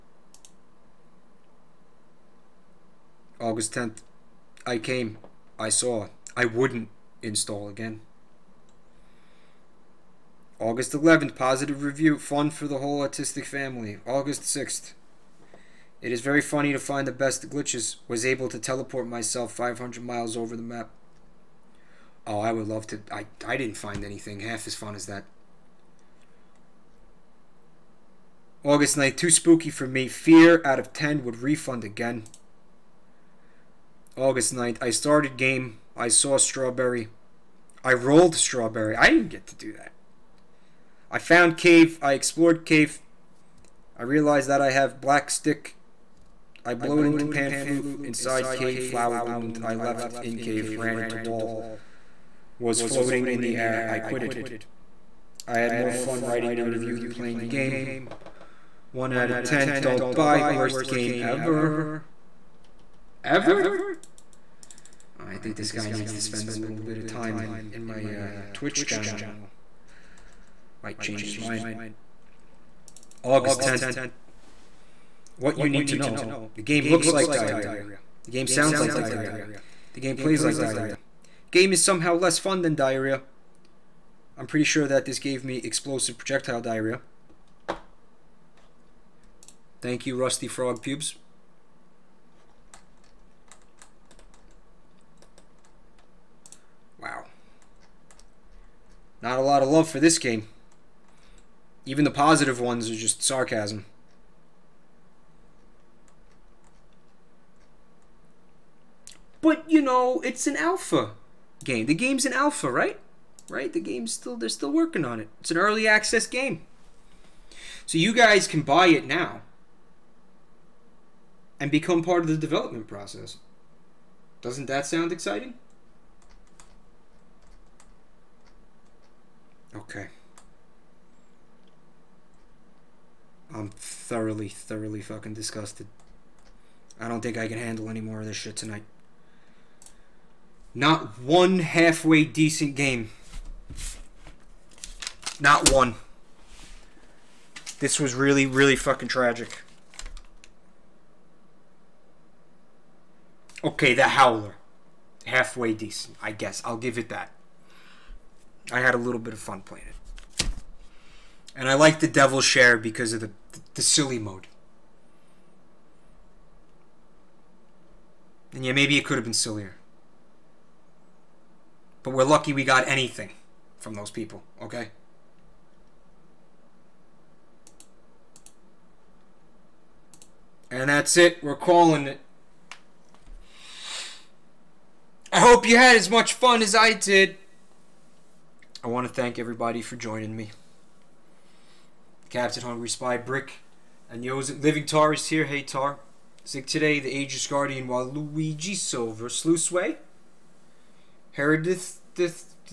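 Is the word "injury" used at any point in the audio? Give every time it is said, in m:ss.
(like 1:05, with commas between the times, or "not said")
not said.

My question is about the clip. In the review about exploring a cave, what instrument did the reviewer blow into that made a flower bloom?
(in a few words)
Pan Flute.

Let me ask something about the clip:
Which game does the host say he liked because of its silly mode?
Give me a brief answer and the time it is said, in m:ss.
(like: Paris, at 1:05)
The Devil's Share, at 2:41.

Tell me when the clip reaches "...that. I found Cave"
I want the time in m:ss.
0:39.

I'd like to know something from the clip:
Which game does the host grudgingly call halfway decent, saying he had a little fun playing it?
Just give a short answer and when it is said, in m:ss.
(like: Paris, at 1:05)
The Howler, at 2:33.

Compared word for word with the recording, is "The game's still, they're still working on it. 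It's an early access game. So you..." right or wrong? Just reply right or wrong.
right.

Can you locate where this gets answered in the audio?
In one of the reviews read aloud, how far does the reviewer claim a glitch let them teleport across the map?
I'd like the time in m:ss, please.
0:19.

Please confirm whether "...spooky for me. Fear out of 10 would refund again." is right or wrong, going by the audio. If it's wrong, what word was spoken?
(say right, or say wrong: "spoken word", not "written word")
right.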